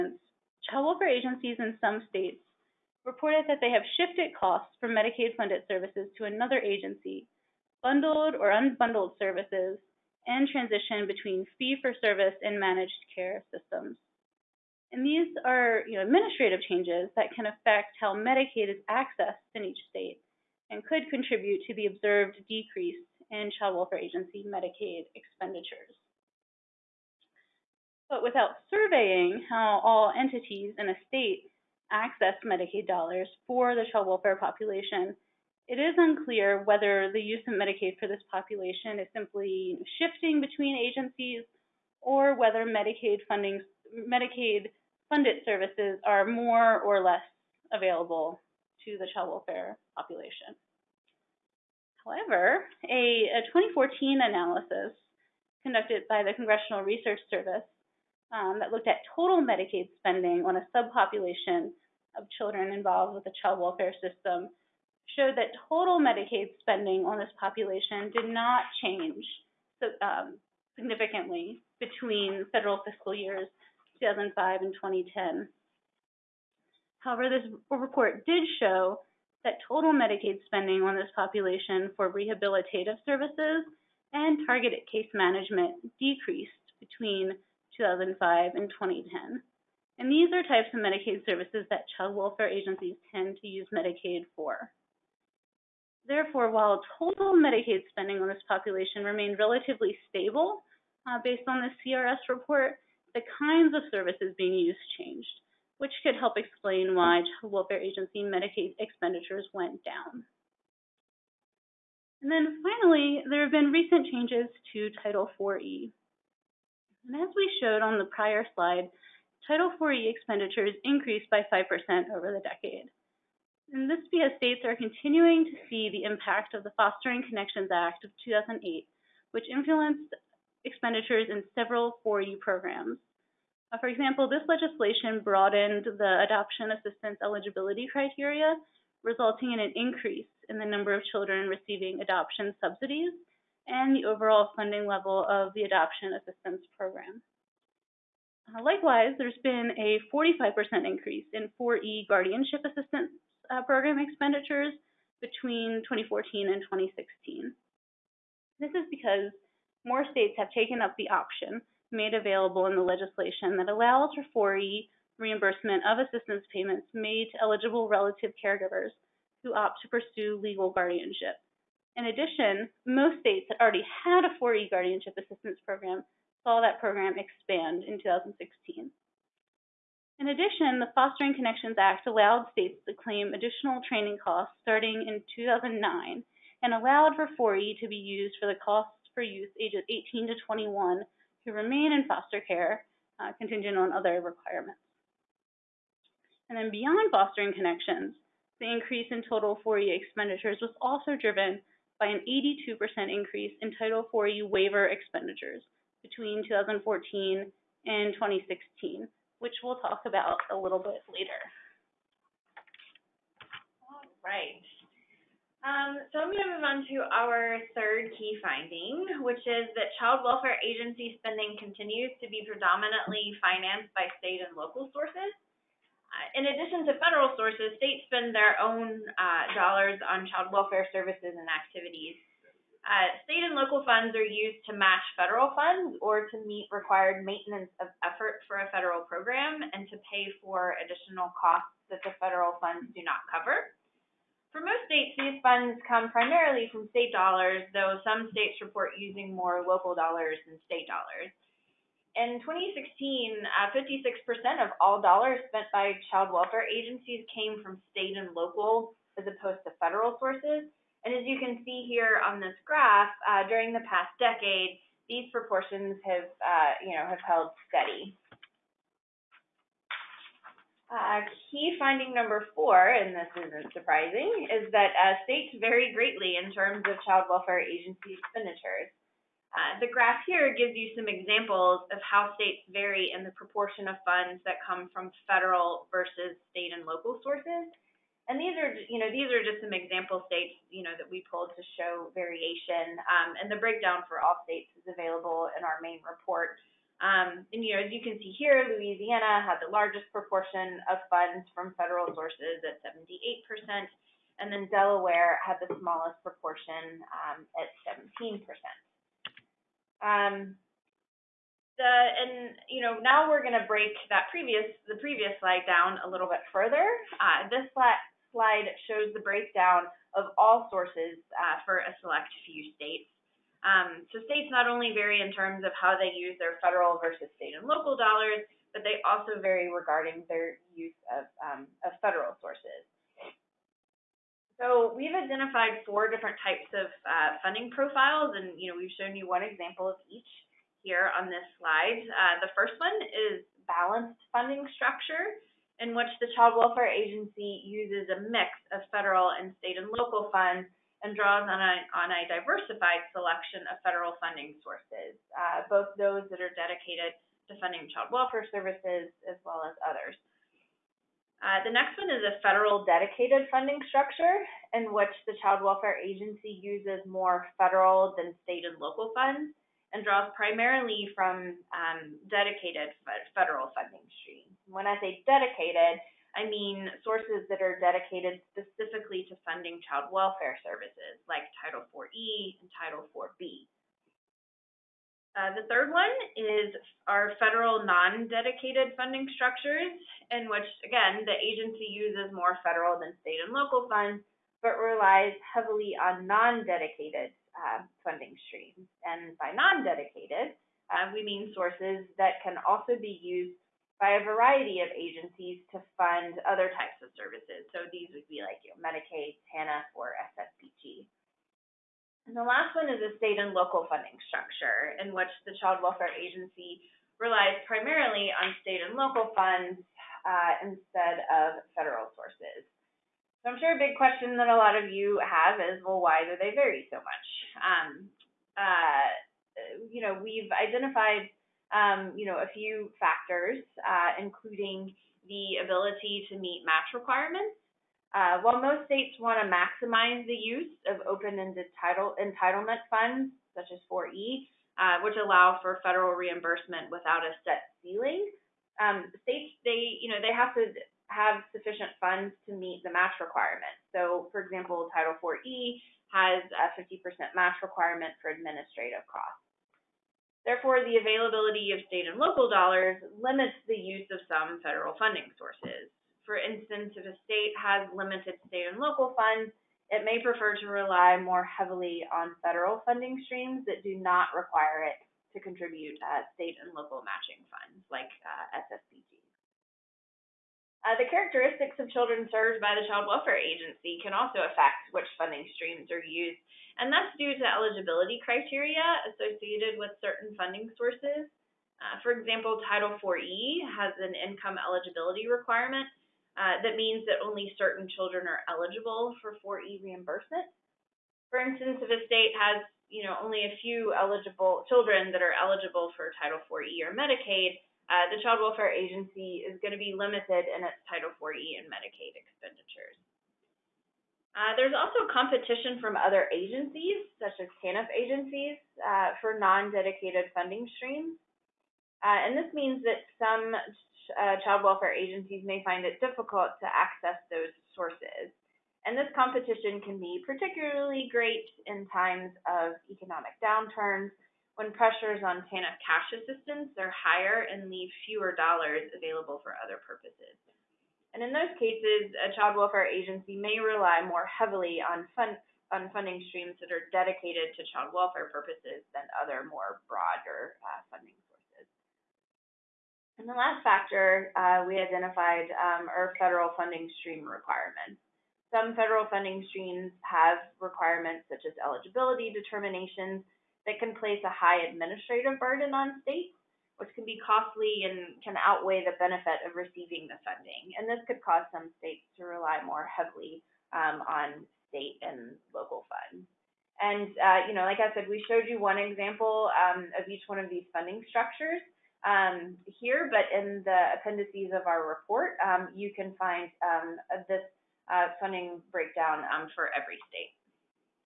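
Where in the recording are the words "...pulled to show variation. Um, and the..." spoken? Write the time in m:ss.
4:51.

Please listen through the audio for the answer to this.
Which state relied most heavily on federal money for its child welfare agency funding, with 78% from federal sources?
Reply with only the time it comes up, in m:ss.
4:58.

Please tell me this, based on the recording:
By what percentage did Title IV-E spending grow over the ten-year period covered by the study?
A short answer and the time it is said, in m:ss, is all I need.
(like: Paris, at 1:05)
5%, at 2:01.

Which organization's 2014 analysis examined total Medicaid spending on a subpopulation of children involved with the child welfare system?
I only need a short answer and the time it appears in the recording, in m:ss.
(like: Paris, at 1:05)
Congressional Research Service, at 0:56.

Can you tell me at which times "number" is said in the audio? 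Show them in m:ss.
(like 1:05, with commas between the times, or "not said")
2:20, 4:32.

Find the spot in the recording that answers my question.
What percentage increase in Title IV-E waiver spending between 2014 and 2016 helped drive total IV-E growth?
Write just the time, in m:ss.
3:22.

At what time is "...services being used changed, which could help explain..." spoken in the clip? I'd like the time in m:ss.
1:43.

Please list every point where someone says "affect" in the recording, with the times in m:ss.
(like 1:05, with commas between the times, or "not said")
0:17, 8:04.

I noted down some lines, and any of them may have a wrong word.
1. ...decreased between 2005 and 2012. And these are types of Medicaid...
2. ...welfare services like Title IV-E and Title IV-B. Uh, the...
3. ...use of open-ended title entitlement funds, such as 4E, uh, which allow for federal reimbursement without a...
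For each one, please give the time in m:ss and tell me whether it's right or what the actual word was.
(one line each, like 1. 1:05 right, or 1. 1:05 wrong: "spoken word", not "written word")
1. 1:26 wrong: "2010", not "2012"
2. 6:20 right
3. 7:20 right.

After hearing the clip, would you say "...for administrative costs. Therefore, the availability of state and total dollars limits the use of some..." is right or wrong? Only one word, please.
wrong.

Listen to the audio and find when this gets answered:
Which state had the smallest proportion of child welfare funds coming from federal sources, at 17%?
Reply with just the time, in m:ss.
5:04.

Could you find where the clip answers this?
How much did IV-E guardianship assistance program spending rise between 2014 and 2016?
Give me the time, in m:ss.
2:30.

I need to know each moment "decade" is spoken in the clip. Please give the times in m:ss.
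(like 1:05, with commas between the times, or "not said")
2:02, 4:24.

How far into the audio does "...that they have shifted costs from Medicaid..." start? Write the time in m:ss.
0:03.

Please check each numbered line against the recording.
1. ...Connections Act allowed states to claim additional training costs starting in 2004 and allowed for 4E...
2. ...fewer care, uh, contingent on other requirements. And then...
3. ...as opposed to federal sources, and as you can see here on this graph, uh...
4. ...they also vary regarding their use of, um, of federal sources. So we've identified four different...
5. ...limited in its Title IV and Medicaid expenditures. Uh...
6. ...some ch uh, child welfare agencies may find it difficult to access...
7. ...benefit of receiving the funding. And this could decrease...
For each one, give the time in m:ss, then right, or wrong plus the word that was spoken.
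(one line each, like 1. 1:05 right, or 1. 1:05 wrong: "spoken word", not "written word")
1. 3:01 wrong: "2009", not "2004"
2. 3:12 wrong: "foster", not "fewer"
3. 4:19 right
4. 5:28 right
5. 8:29 right
6. 8:43 right
7. 9:28 wrong: "cause", not "decrease".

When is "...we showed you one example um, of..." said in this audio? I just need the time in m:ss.
9:38.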